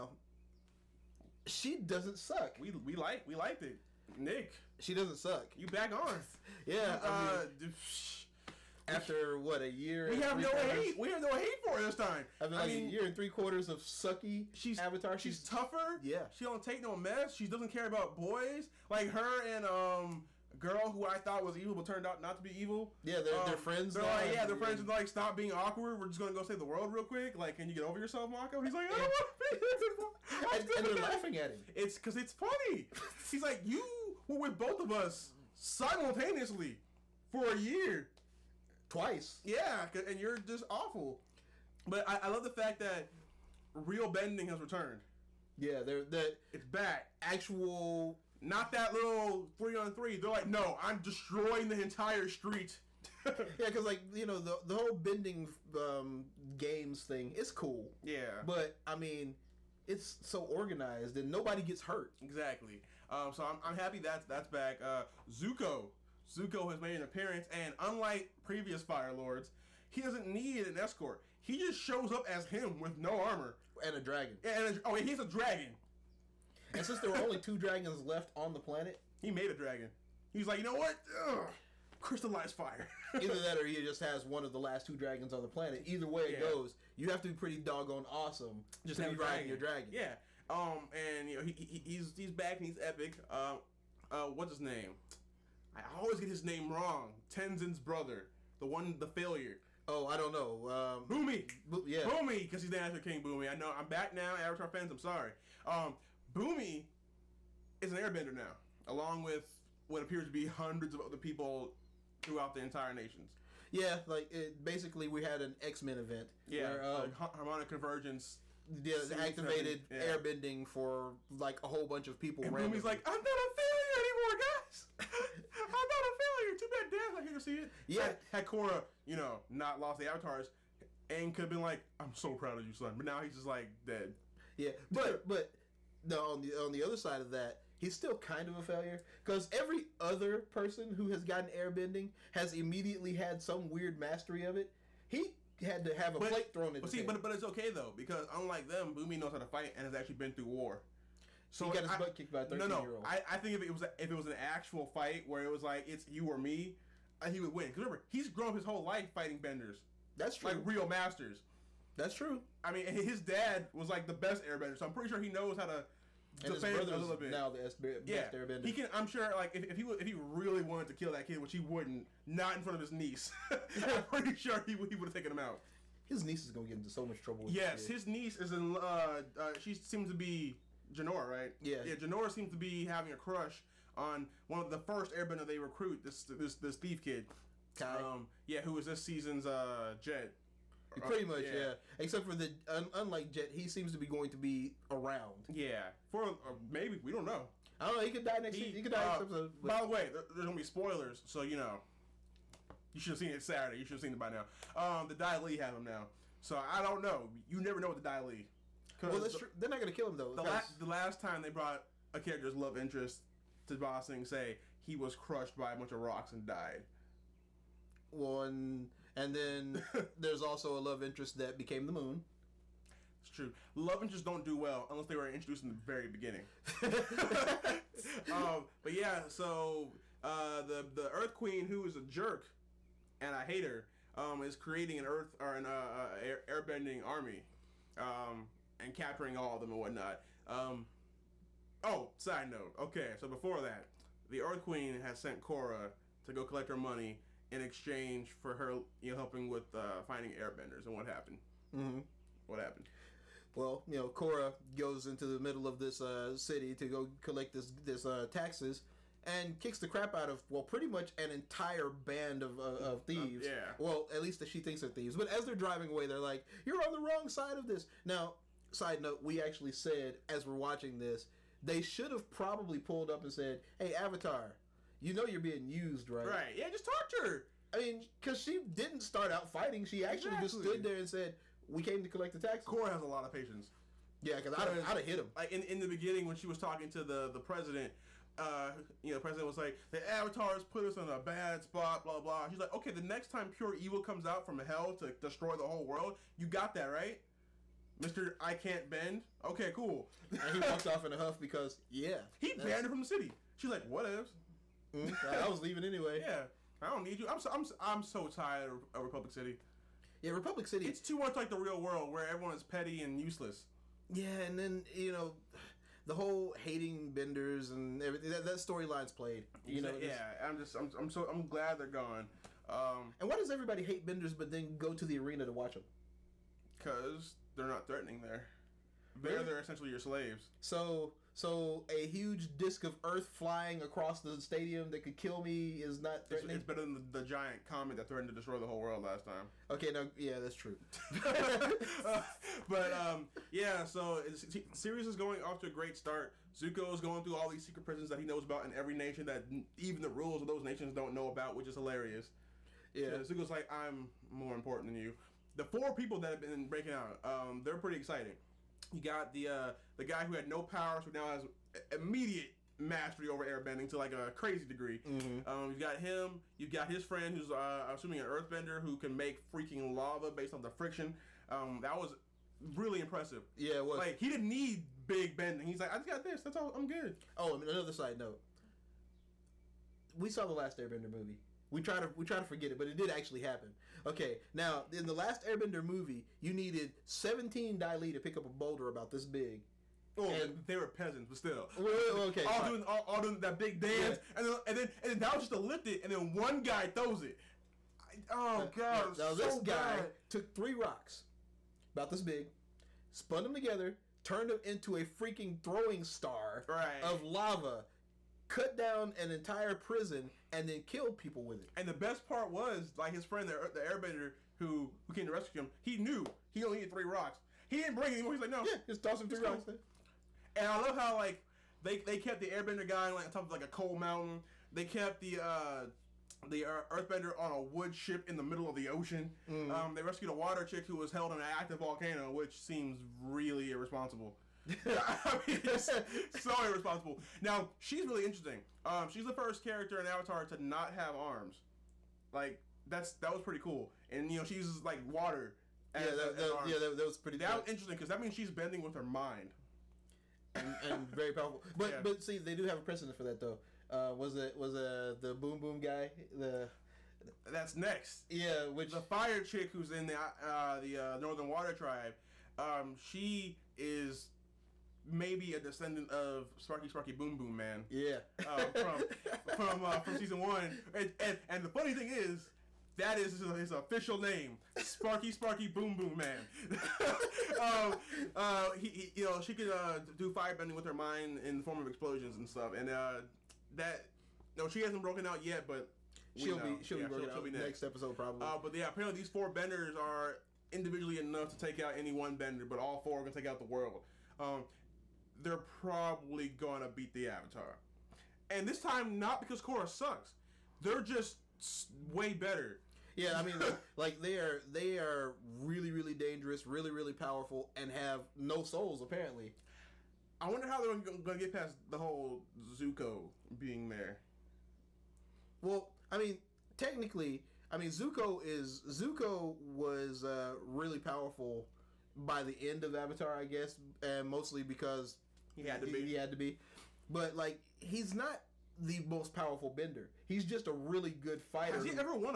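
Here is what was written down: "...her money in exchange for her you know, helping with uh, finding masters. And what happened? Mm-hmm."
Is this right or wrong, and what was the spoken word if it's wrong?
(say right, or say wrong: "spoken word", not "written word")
wrong: "airbenders", not "masters".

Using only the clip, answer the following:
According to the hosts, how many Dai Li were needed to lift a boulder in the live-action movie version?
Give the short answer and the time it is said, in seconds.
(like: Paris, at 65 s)
17, at 387 s.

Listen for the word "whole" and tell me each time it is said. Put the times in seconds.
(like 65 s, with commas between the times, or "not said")
54 s, 121 s, 158 s, 295 s, 316 s, 338 s, 511 s.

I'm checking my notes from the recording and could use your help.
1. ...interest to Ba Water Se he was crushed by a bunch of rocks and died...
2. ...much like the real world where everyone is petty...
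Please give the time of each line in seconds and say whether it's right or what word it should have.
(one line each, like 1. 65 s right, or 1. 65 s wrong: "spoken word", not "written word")
1. 212 s wrong: "Sing", not "Water"
2. 311 s right.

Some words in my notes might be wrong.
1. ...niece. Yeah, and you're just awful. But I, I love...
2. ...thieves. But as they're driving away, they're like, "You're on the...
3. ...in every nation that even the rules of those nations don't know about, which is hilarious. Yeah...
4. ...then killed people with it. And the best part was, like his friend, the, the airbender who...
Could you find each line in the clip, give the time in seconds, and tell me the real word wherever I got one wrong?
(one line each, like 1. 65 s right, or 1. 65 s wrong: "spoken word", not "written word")
1. 38 s wrong: "twice", not "niece"
2. 264 s right
3. 348 s right
4. 410 s right.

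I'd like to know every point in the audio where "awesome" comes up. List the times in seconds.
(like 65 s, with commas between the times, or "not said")
88 s.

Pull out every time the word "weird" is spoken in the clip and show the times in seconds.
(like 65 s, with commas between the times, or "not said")
143 s.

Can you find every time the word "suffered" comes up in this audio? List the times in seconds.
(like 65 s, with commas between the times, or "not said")
not said.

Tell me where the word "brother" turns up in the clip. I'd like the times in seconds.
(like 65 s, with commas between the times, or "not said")
97 s, 166 s.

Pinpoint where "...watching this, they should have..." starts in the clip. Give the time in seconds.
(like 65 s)
270 s.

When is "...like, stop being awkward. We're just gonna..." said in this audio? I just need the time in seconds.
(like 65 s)
24 s.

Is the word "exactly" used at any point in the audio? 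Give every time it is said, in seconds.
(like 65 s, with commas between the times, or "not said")
62 s, 280 s.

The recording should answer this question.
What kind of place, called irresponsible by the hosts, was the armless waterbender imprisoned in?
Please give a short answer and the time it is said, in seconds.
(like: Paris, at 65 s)
An active volcano, at 431 s.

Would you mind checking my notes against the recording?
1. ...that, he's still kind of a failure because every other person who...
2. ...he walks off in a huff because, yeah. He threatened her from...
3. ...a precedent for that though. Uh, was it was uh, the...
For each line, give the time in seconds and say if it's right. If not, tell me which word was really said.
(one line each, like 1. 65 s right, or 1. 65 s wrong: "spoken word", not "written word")
1. 137 s right
2. 300 s wrong: "banned", not "threatened"
3. 452 s right.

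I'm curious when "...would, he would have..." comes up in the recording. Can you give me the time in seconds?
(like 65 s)
174 s.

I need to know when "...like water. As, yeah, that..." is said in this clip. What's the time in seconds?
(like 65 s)
444 s.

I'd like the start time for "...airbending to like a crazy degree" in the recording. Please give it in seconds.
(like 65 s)
363 s.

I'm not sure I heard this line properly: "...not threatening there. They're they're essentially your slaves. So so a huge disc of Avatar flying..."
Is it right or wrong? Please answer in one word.
wrong.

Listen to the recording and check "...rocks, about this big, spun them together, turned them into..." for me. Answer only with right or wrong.
right.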